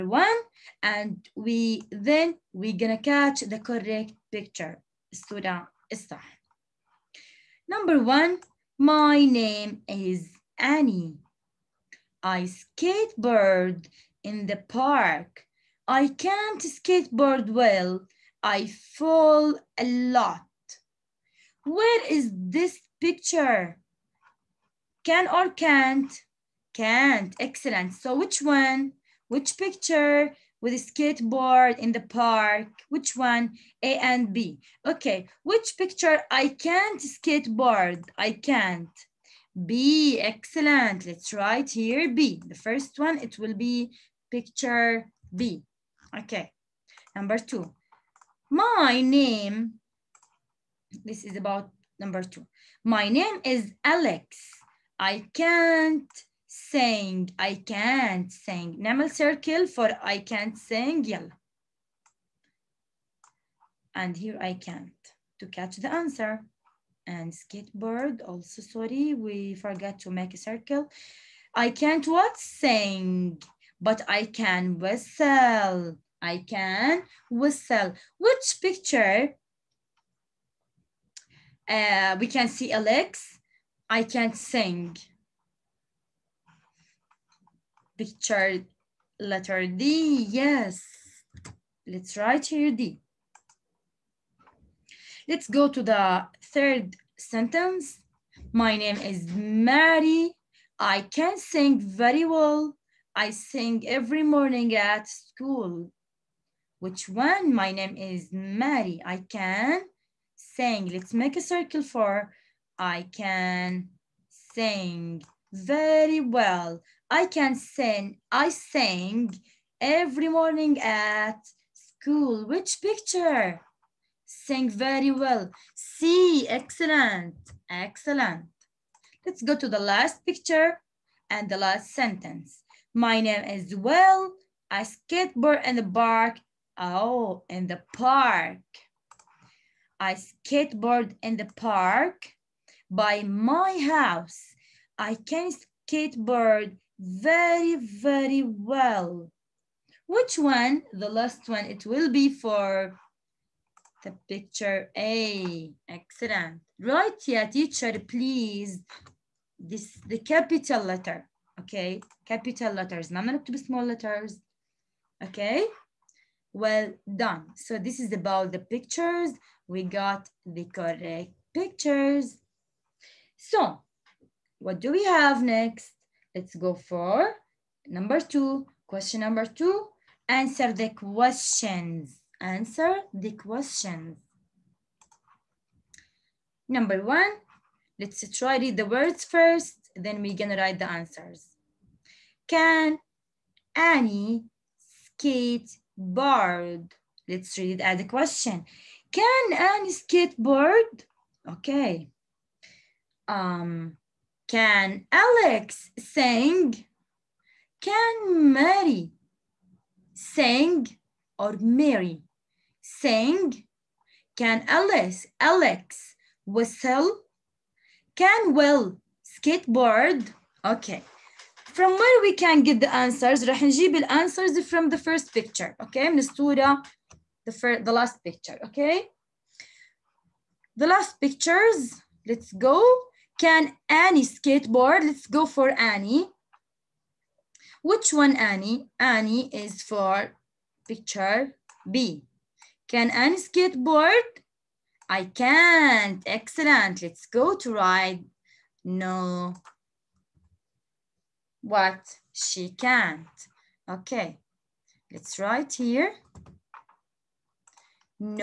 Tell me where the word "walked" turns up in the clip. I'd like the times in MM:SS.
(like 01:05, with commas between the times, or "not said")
not said.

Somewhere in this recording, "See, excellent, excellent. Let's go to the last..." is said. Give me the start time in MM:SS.
02:05.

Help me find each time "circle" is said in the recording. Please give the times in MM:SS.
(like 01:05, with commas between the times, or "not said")
00:59, 01:10, 01:51.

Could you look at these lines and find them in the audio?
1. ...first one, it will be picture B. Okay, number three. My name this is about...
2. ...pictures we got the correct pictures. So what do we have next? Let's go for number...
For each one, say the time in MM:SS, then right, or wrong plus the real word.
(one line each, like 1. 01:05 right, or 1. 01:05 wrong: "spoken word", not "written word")
1. 00:42 wrong: "two", not "three"
2. 02:48 right.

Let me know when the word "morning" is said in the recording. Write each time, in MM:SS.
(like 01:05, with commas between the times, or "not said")
01:44, 02:00.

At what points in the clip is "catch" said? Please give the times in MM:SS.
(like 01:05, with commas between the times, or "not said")
00:02, 01:05.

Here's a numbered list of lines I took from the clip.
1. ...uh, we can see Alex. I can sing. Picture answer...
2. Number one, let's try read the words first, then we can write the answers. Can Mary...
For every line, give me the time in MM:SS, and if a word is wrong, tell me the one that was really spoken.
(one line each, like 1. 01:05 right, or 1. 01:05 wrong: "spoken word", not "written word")
1. 01:21 wrong: "letter", not "answer"
2. 03:06 wrong: "Annie", not "Mary".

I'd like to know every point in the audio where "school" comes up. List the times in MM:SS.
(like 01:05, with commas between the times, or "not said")
01:45, 02:01.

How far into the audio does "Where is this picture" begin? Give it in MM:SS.
00:21.